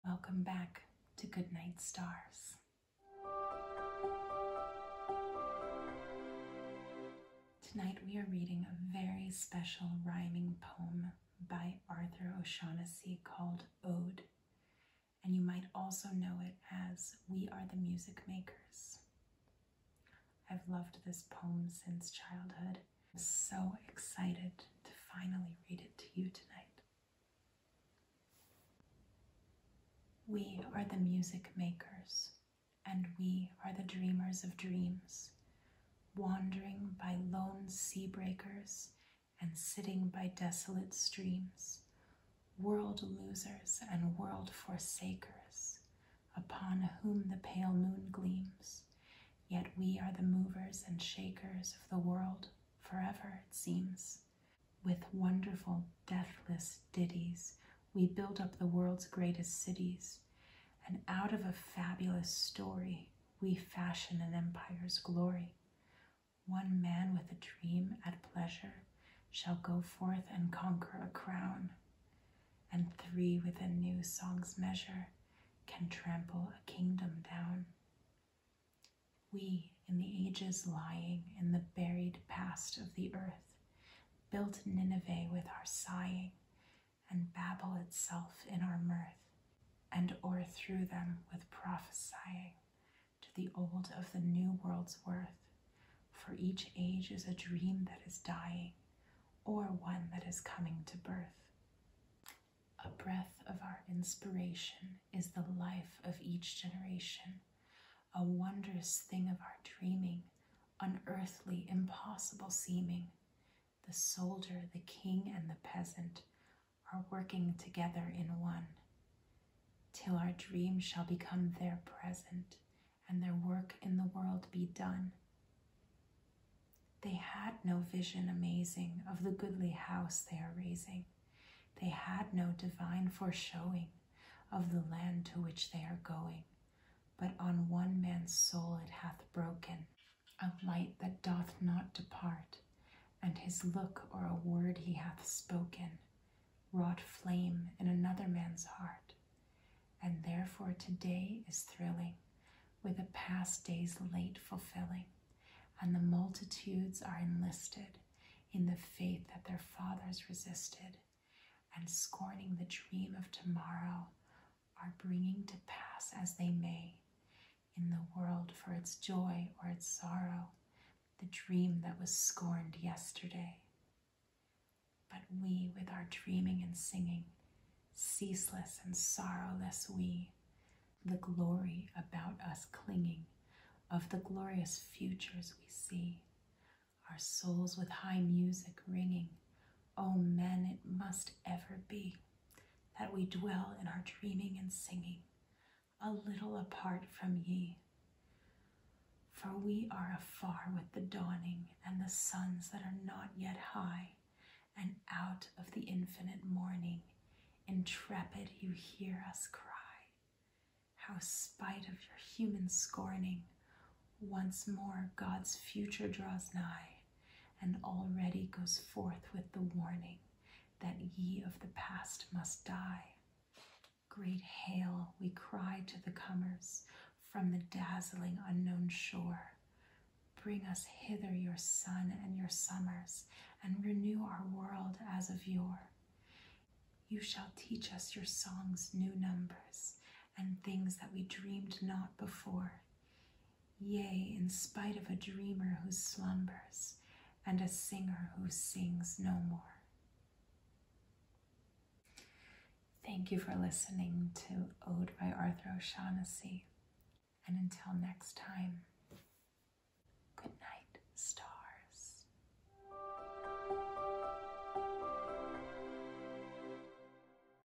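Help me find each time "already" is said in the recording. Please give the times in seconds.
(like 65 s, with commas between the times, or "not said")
217 s.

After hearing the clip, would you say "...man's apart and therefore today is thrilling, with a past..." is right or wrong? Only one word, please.
wrong.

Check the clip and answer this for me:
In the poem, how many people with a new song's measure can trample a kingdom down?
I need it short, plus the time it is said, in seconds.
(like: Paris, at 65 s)
3, at 72 s.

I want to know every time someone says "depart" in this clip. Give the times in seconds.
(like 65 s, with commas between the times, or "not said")
141 s.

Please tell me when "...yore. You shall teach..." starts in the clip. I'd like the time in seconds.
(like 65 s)
235 s.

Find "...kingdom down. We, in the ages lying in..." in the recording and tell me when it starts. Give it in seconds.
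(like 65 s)
76 s.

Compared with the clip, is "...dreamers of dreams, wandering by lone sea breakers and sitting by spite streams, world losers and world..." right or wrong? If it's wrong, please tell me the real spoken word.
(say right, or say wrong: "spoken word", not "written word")
wrong: "desolate", not "spite".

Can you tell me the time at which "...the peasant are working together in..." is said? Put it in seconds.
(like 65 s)
115 s.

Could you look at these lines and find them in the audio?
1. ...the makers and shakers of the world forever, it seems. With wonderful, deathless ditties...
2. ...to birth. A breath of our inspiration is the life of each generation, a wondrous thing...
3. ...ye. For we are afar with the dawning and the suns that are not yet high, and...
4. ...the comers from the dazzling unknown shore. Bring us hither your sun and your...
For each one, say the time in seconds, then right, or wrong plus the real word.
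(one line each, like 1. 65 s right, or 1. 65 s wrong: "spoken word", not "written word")
1. 50 s wrong: "movers", not "makers"
2. 100 s right
3. 197 s right
4. 226 s right.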